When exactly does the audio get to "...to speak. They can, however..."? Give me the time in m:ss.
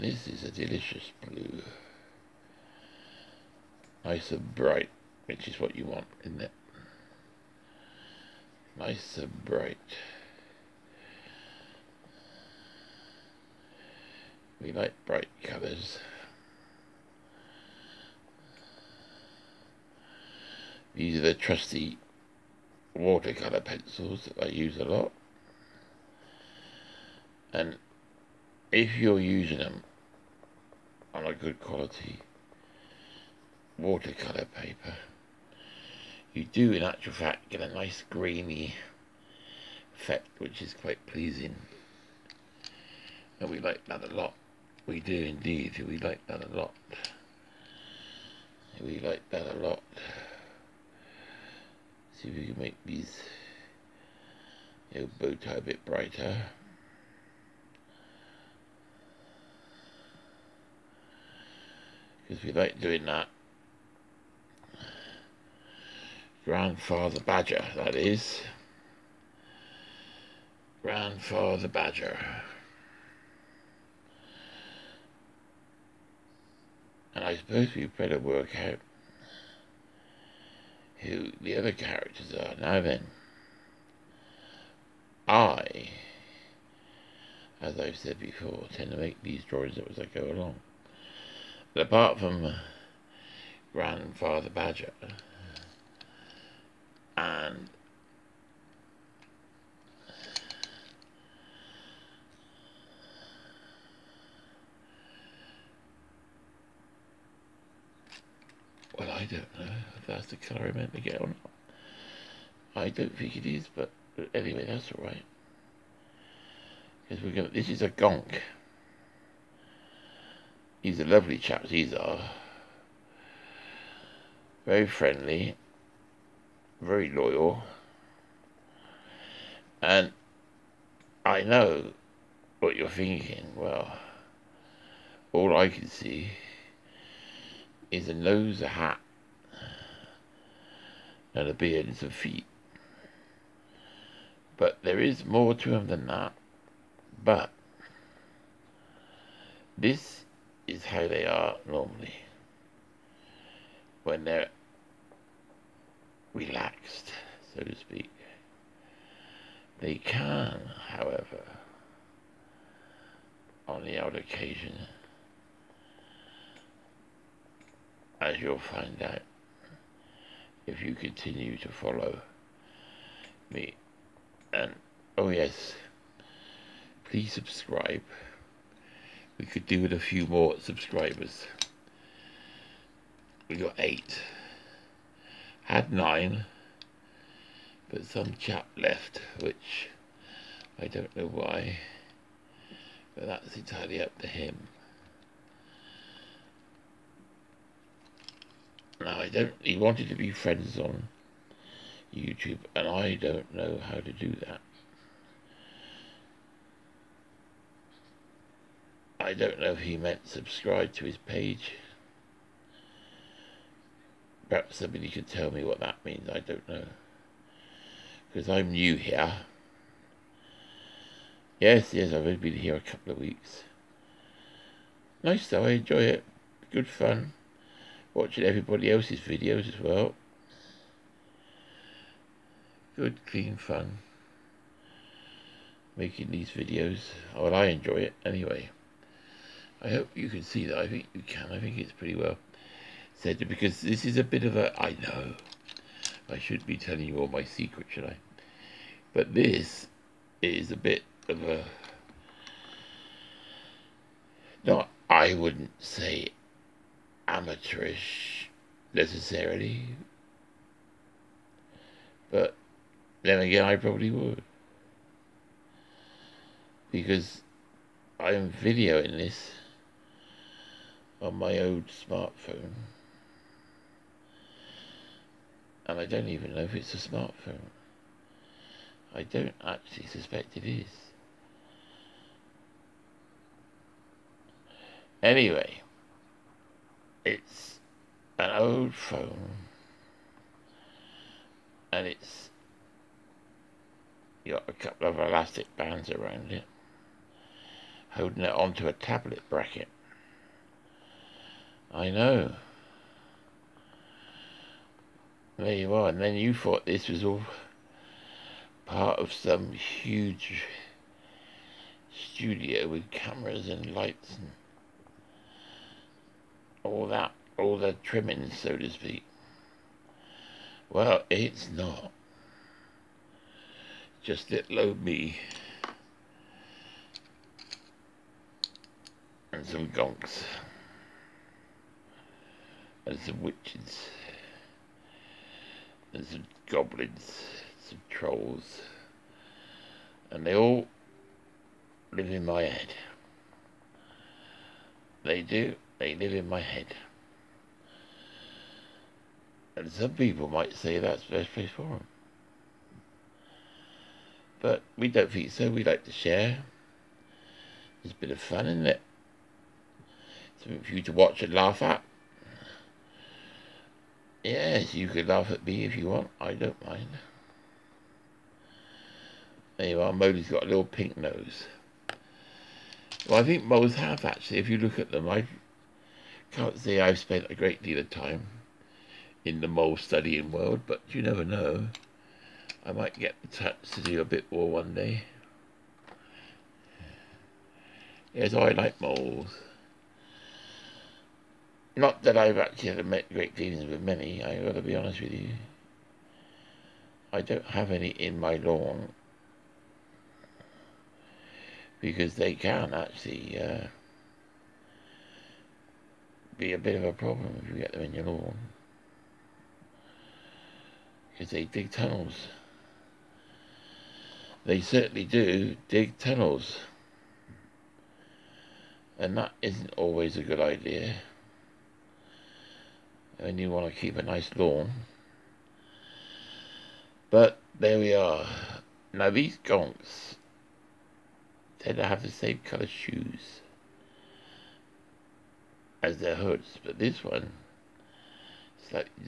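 2:37.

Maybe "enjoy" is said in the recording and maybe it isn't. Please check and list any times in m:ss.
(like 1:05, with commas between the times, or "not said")
3:45, 3:57.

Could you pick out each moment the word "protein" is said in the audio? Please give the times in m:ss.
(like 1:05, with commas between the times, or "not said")
not said.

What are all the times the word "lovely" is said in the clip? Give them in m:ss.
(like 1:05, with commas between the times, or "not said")
2:01.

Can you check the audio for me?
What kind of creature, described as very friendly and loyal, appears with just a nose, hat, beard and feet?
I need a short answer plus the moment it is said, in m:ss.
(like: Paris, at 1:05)
gonk, at 1:57.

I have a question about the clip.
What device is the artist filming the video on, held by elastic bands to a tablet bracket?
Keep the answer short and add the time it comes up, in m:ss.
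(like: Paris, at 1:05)
old smartphone, at 4:31.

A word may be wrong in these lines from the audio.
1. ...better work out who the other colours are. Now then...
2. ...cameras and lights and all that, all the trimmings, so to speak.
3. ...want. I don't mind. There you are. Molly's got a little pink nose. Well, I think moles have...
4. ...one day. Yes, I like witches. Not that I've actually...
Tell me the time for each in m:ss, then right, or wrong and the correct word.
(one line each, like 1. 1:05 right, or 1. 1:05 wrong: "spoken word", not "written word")
1. 1:17 wrong: "characters", not "colours"
2. 5:13 right
3. 6:06 right
4. 6:24 wrong: "moles", not "witches".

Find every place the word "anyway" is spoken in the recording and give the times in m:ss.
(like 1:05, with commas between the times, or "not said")
1:54, 3:58, 4:45.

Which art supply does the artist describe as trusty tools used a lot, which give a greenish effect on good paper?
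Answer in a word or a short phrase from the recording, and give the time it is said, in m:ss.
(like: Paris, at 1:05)
watercolor pencils, at 0:22.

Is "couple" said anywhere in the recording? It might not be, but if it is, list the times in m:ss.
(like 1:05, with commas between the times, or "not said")
3:42, 4:54.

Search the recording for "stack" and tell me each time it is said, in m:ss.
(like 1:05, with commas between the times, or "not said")
not said.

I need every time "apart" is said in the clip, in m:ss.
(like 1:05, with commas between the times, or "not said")
1:31.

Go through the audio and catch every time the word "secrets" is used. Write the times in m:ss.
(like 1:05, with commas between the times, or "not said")
4:07.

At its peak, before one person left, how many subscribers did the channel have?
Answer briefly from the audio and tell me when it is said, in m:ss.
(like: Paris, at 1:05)
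9, at 3:05.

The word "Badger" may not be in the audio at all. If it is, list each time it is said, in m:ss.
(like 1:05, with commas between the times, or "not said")
1:07, 1:11, 1:34.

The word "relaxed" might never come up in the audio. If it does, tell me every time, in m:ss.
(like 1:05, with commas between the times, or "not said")
2:36.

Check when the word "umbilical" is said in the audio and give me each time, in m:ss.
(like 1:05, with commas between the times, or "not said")
not said.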